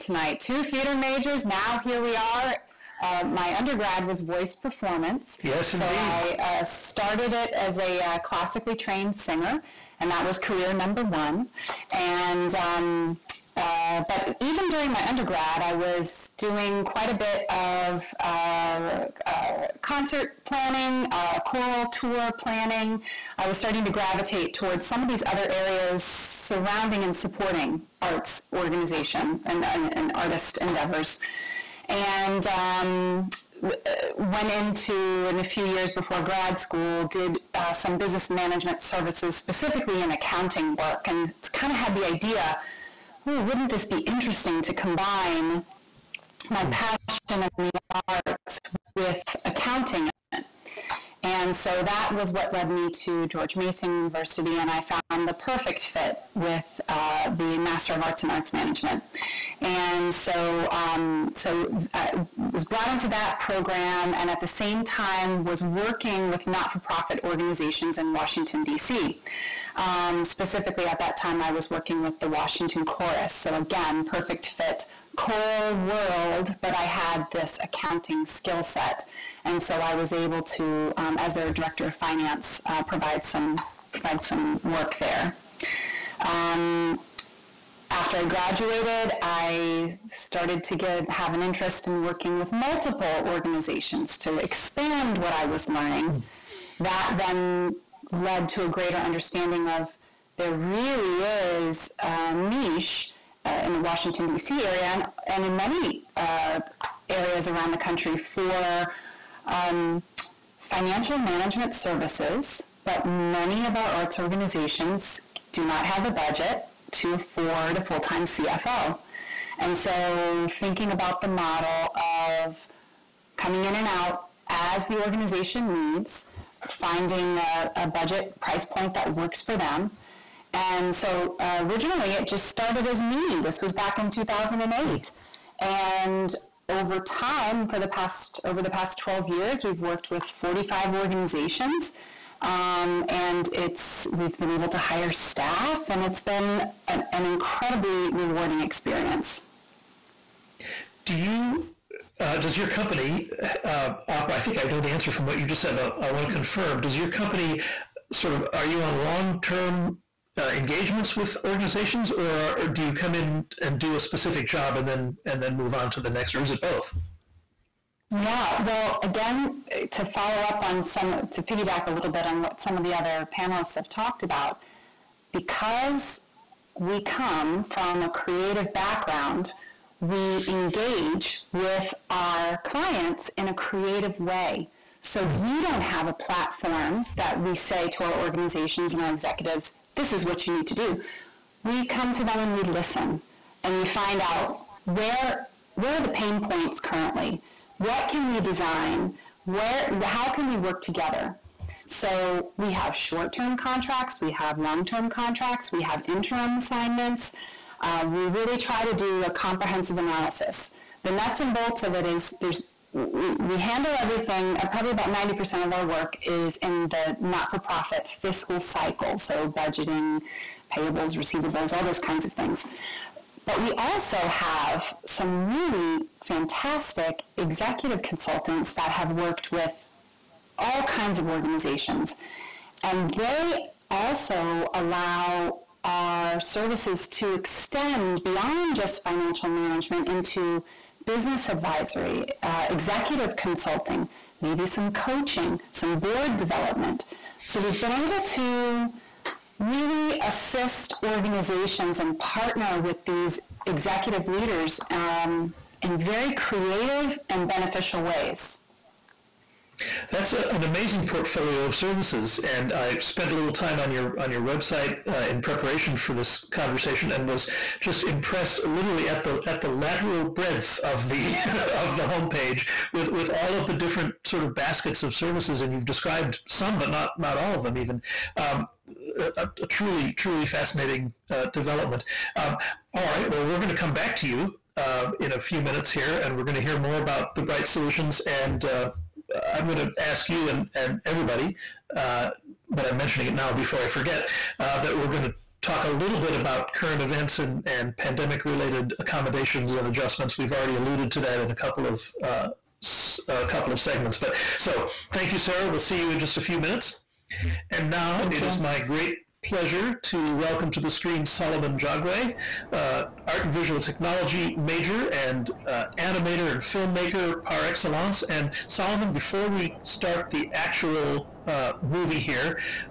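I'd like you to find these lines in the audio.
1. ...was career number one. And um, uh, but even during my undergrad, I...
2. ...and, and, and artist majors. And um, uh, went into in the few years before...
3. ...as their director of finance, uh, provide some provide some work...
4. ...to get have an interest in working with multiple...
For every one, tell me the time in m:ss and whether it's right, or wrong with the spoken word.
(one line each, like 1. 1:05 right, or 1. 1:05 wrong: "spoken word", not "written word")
1. 0:10 right
2. 0:29 wrong: "endeavors", not "majors"
3. 1:21 right
4. 1:30 right.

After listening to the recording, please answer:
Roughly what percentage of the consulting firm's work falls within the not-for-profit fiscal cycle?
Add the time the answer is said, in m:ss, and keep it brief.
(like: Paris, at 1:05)
90%, at 3:35.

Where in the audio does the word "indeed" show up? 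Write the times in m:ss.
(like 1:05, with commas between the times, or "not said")
0:05.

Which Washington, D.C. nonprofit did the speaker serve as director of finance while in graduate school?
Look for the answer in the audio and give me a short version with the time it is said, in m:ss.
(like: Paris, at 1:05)
the Washington Chorus, at 1:12.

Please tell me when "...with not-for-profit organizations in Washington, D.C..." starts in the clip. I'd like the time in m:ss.
1:06.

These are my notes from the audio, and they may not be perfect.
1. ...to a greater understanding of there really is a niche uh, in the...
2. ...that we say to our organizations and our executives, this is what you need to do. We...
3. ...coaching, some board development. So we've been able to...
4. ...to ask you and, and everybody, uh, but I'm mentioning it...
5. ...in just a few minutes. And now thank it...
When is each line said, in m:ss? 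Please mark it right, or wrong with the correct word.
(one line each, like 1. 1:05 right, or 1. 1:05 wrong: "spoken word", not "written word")
1. 1:38 right
2. 3:07 right
3. 4:04 right
4. 4:49 right
5. 5:06 right.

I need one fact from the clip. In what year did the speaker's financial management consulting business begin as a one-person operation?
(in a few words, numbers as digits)
2008.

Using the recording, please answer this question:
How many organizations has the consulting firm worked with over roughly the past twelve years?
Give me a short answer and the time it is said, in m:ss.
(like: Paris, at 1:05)
45, at 2:20.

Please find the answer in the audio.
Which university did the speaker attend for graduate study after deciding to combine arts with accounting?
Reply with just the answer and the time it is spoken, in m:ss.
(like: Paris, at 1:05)
George Mason University, at 0:53.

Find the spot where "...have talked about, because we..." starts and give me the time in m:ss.
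2:53.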